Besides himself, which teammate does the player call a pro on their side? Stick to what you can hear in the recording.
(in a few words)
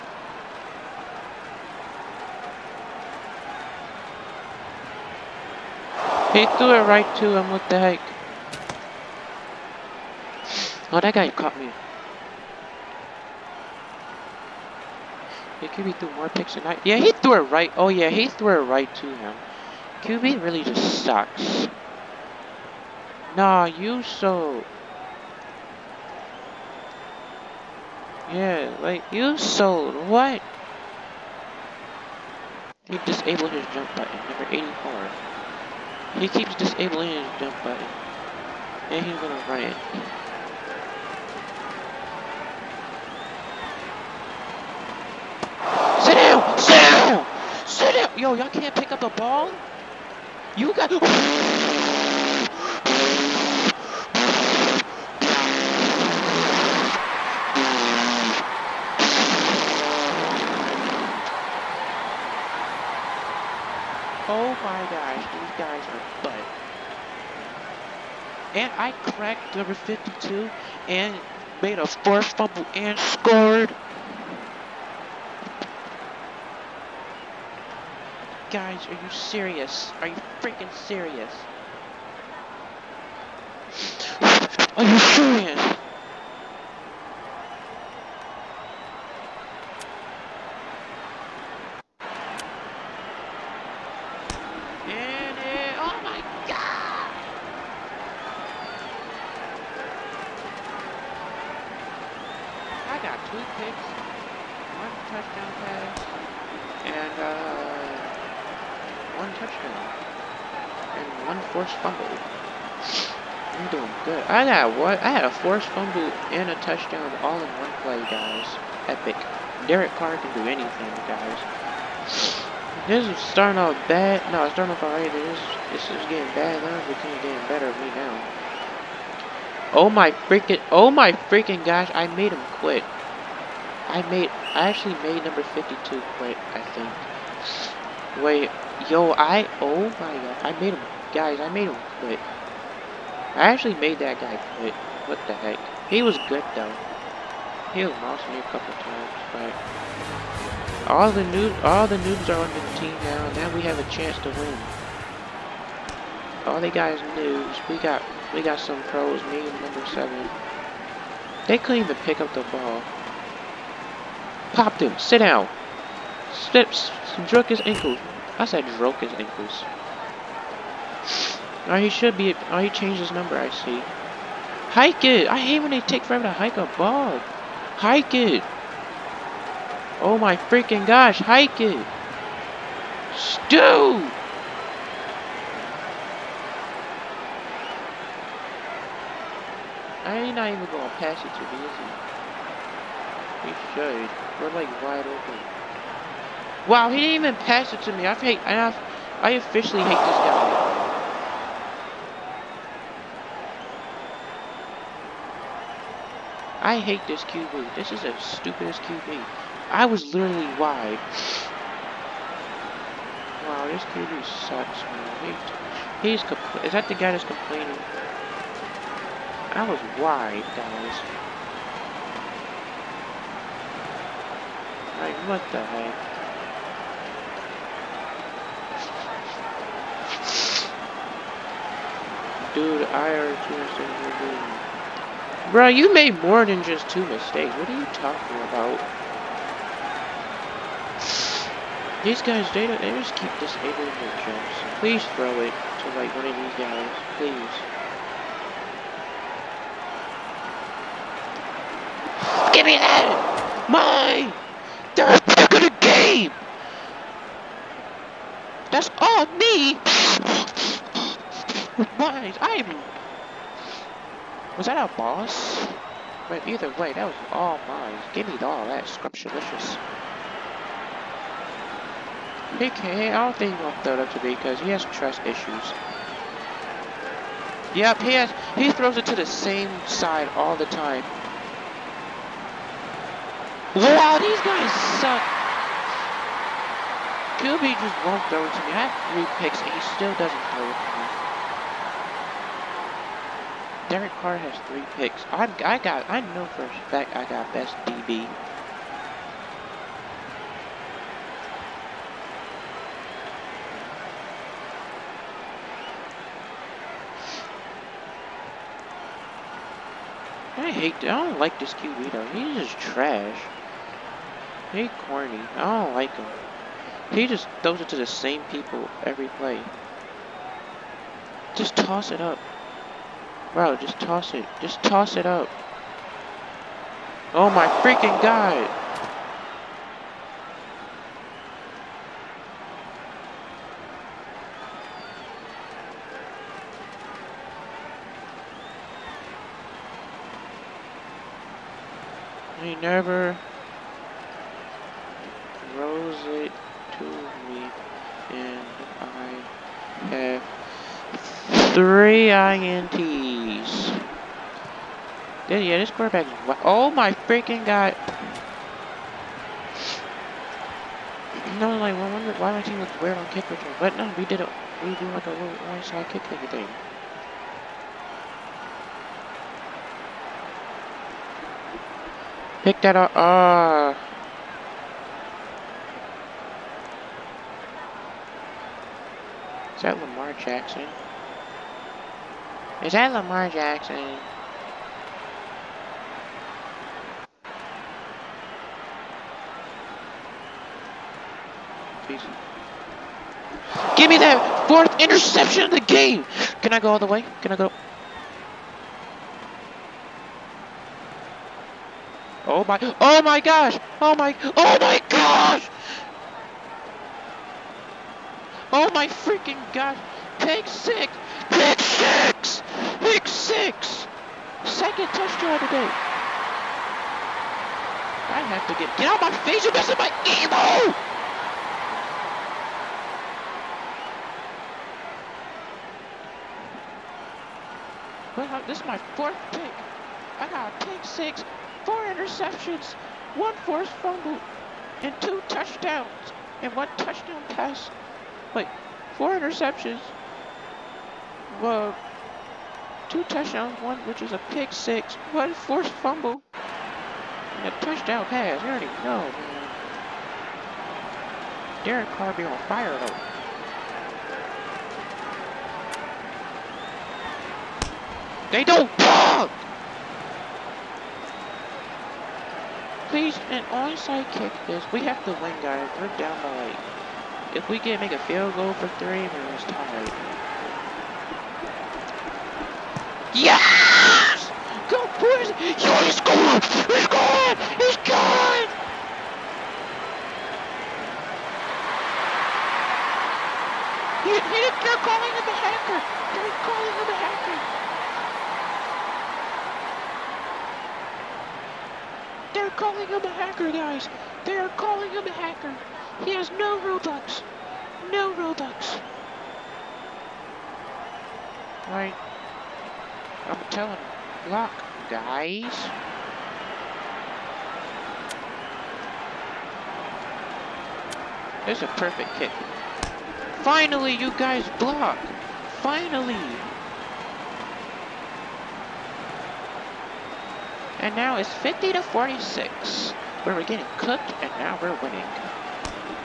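Number seven.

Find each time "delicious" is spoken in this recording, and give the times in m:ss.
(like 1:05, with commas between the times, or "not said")
not said.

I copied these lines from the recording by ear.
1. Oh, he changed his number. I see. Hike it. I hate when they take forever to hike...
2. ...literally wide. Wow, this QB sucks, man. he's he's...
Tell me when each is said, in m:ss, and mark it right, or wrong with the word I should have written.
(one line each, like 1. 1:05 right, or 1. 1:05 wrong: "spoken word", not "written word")
1. 2:52 right
2. 3:30 right.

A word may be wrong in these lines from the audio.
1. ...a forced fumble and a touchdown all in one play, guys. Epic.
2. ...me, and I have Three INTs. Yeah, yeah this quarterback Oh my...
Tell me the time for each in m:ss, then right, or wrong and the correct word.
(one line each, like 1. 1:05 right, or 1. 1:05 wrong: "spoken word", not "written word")
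1. 1:55 right
2. 5:47 right.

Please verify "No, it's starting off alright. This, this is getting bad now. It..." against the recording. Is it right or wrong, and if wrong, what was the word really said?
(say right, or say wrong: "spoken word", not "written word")
right.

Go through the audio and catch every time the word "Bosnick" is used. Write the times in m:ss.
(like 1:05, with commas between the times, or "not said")
not said.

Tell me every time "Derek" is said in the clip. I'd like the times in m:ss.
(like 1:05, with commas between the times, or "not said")
1:59, 4:53, 7:31.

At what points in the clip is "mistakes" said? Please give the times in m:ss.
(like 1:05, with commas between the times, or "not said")
3:57.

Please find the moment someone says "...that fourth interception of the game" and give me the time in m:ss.
6:34.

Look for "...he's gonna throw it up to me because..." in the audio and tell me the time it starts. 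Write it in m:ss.
4:33.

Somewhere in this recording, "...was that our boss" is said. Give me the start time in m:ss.
4:24.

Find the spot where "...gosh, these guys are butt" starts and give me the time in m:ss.
1:04.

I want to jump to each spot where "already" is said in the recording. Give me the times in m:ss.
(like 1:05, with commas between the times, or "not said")
3:53, 7:28.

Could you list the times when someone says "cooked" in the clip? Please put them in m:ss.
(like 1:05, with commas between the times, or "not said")
8:43.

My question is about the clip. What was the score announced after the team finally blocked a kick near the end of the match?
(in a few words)
50 to 46.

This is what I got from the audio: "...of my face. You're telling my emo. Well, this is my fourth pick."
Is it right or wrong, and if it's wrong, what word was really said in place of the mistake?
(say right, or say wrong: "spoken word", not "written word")
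wrong: "messing", not "telling".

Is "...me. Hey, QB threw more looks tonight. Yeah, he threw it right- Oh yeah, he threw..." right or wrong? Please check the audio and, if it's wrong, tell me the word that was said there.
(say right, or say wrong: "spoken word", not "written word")
wrong: "picks", not "looks".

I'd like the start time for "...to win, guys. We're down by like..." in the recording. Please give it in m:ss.
7:45.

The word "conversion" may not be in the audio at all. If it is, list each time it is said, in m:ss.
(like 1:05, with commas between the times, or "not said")
not said.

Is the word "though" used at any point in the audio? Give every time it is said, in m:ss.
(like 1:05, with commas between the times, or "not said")
2:26, 5:12, 7:32.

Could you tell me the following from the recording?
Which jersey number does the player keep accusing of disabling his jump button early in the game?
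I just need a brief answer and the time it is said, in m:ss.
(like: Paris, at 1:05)
84, at 0:34.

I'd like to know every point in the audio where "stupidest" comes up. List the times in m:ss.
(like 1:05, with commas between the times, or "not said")
3:28.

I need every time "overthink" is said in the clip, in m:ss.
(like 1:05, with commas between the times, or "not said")
not said.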